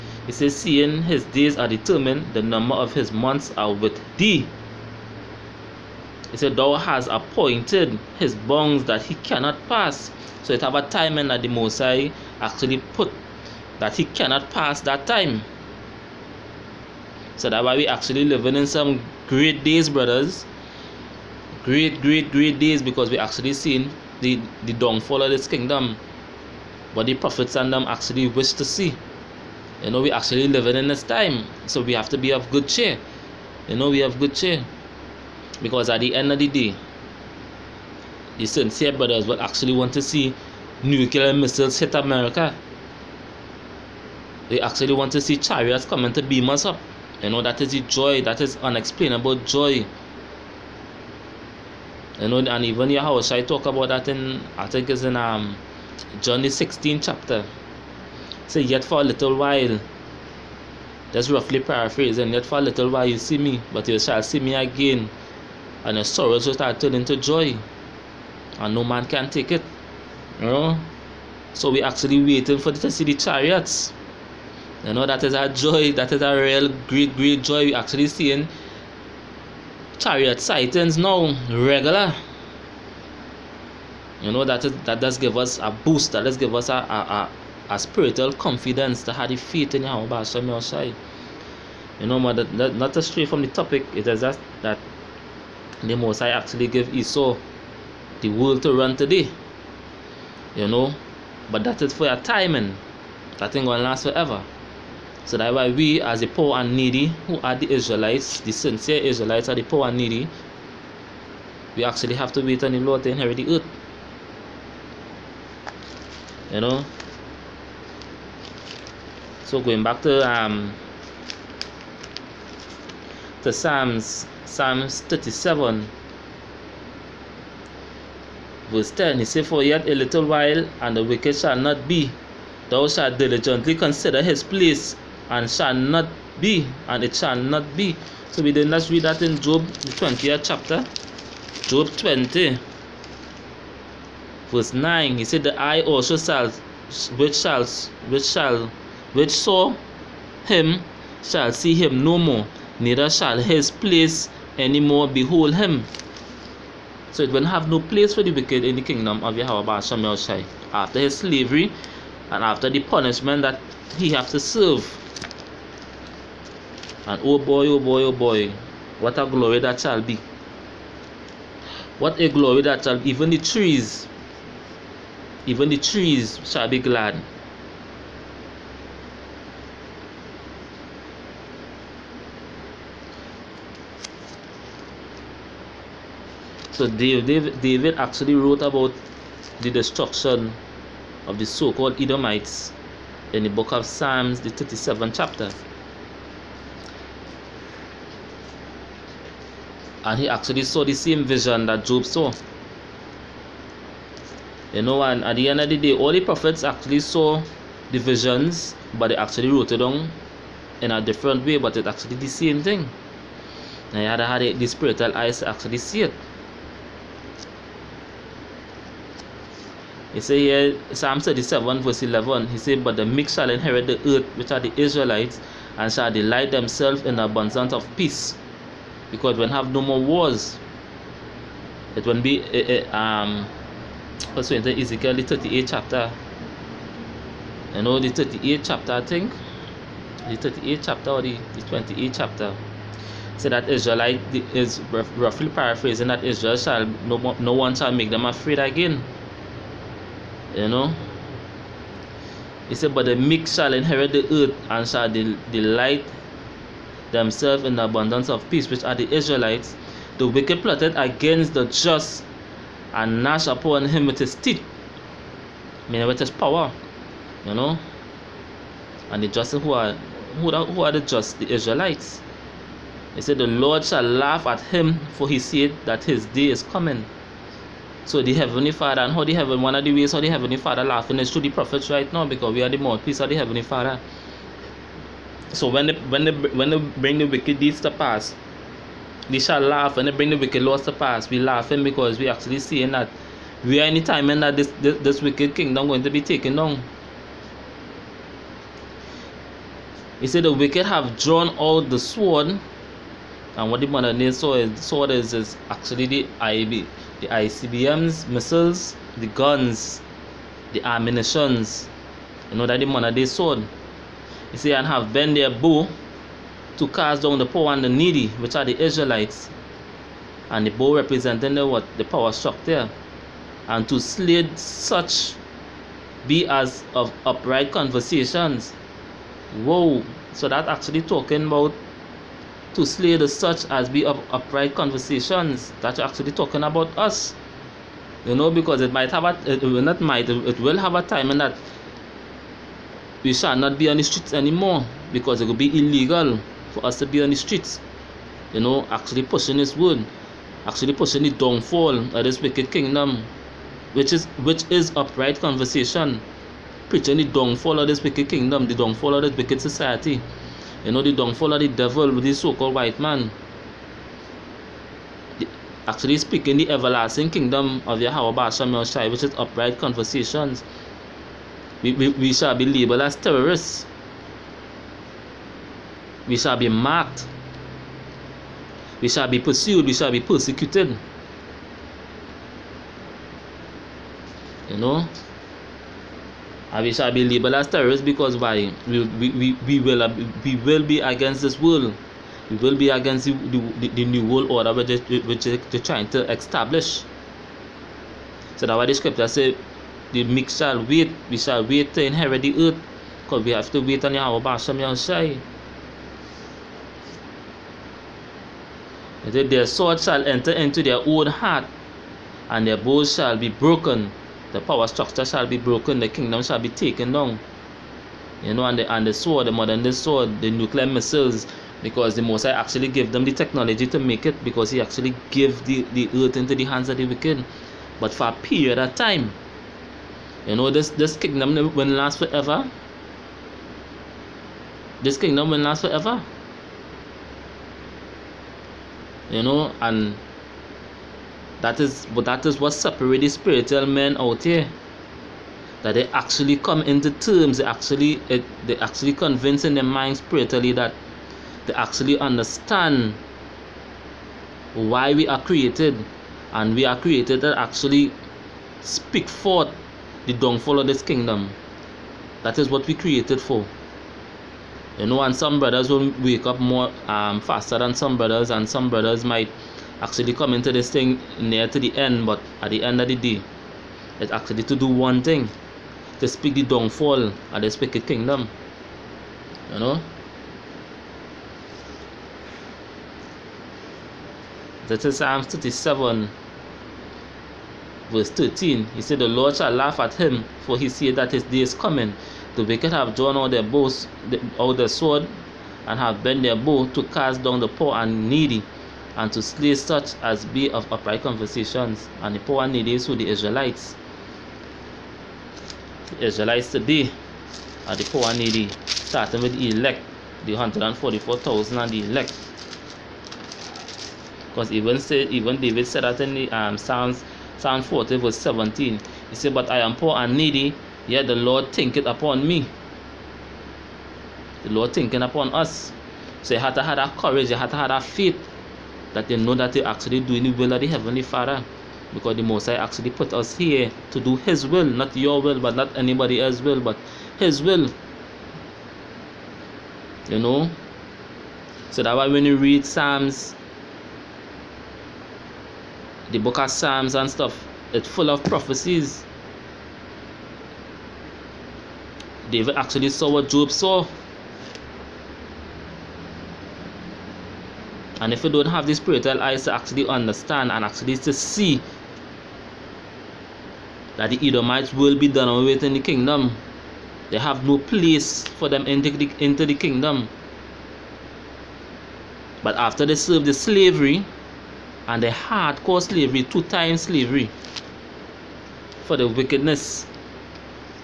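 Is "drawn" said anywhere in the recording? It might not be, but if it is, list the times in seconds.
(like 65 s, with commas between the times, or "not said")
301 s, 493 s.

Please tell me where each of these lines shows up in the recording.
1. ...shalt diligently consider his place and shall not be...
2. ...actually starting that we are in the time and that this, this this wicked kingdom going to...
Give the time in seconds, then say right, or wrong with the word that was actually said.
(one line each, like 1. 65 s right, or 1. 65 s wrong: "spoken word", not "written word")
1. 132 s right
2. 292 s wrong: "seeing", not "starting".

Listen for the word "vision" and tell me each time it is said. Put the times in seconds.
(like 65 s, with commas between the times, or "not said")
201 s, 207 s.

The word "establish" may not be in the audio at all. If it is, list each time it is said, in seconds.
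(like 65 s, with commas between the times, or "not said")
396 s.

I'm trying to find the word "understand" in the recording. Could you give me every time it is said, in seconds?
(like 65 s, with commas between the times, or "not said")
452 s, 560 s.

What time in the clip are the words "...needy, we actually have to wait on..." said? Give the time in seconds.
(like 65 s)
109 s.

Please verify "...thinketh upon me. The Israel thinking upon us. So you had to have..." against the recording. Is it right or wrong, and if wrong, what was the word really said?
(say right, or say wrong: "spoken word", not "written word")
wrong: "Lord", not "Israel".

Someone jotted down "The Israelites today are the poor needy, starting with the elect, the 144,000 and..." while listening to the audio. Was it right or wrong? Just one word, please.
right.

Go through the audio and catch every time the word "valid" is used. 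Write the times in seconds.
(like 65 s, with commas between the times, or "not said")
not said.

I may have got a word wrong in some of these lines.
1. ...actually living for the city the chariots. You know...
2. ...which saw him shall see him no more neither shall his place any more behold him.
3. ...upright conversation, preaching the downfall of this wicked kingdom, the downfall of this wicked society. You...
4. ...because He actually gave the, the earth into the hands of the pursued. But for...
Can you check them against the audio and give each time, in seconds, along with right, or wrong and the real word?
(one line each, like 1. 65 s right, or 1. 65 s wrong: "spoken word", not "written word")
1. 71 s wrong: "waiting", not "living"
2. 149 s right
3. 354 s right
4. 424 s wrong: "wicked", not "pursued".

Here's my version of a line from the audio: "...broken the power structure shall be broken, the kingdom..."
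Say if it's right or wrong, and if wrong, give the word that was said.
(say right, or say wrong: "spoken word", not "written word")
right.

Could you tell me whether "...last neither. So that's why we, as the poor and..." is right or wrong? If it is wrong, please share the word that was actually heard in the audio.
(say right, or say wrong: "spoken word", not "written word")
wrong: "forever", not "neither".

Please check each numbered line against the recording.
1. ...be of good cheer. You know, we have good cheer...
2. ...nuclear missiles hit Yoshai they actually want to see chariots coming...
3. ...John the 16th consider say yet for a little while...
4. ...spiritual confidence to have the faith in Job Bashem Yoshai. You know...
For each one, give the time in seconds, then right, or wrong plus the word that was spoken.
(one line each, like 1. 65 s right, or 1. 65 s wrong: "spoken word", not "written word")
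1. 32 s right
2. 40 s wrong: "America", not "Yoshai"
3. 56 s wrong: "chapter", not "consider"
4. 87 s wrong: "Yahweh", not "Job".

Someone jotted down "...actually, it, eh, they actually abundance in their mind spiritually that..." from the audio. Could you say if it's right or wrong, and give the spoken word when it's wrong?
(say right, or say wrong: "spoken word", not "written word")
wrong: "convince", not "abundance".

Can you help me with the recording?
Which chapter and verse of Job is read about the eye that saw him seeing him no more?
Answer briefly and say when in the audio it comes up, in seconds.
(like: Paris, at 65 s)
Job 20:9, at 141 s.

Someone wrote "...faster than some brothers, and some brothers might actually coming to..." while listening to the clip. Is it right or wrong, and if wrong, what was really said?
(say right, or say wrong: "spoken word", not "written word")
right.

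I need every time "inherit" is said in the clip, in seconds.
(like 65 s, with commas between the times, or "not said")
113 s, 223 s, 253 s, 402 s.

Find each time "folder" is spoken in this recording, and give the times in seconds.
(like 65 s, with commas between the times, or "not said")
not said.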